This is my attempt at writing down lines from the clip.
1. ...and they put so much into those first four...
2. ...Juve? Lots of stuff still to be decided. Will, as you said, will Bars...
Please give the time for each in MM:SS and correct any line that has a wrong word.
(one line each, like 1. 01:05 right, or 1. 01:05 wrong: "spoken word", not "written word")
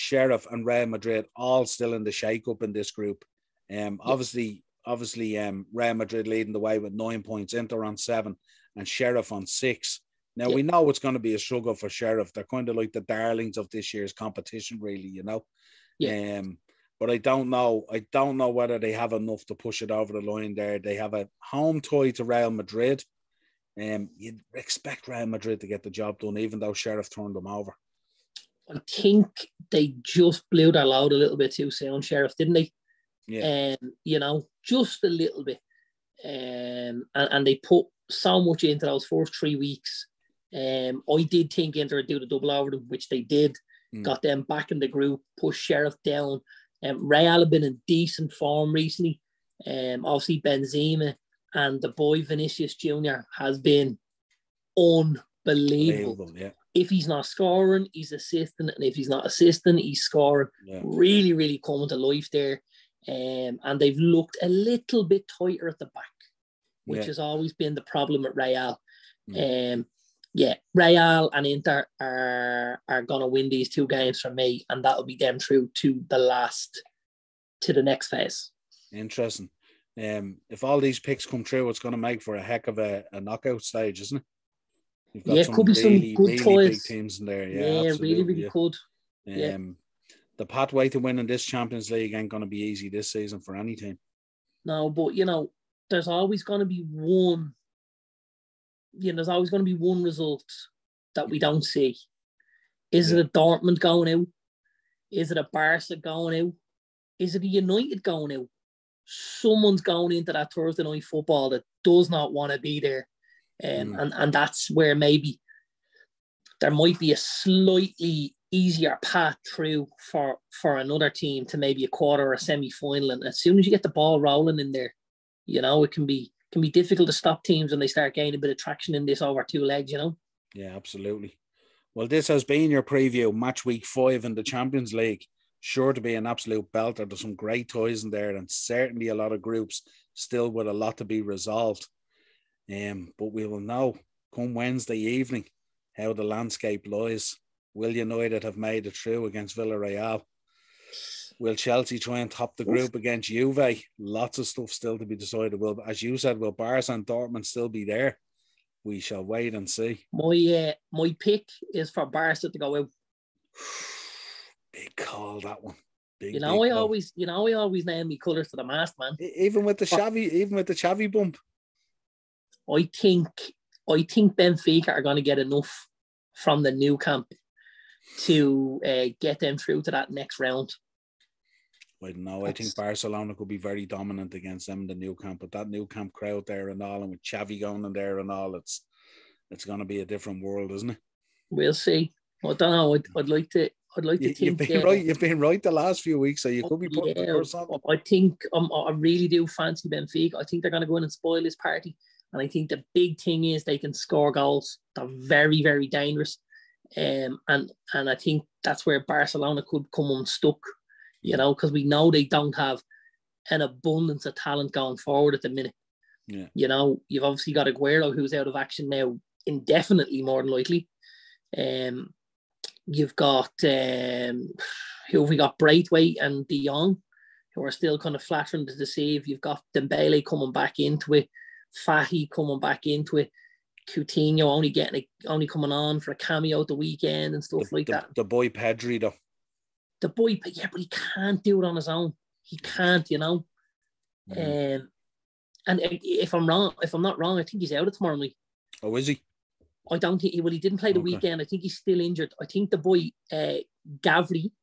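1. 00:37 wrong: "three", not "four"
2. 02:33 right.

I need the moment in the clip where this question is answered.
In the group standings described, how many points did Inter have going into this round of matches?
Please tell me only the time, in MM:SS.
00:07.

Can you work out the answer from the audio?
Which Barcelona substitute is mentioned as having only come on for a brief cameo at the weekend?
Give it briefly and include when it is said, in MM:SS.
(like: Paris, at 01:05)
Coutinho, at 03:53.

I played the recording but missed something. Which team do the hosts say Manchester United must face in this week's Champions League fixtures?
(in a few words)
Villarreal.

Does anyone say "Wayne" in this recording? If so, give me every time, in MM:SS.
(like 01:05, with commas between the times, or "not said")
not said.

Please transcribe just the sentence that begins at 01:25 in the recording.
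You've got yeah, it could be really, some good really toys.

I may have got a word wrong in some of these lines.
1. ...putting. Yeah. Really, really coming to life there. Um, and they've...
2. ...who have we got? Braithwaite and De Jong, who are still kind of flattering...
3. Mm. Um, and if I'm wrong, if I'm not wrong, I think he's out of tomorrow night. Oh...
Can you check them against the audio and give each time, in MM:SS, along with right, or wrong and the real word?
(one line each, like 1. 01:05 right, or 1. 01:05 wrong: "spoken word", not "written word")
1. 01:00 wrong: "scoring", not "putting"
2. 03:45 right
3. 04:04 right.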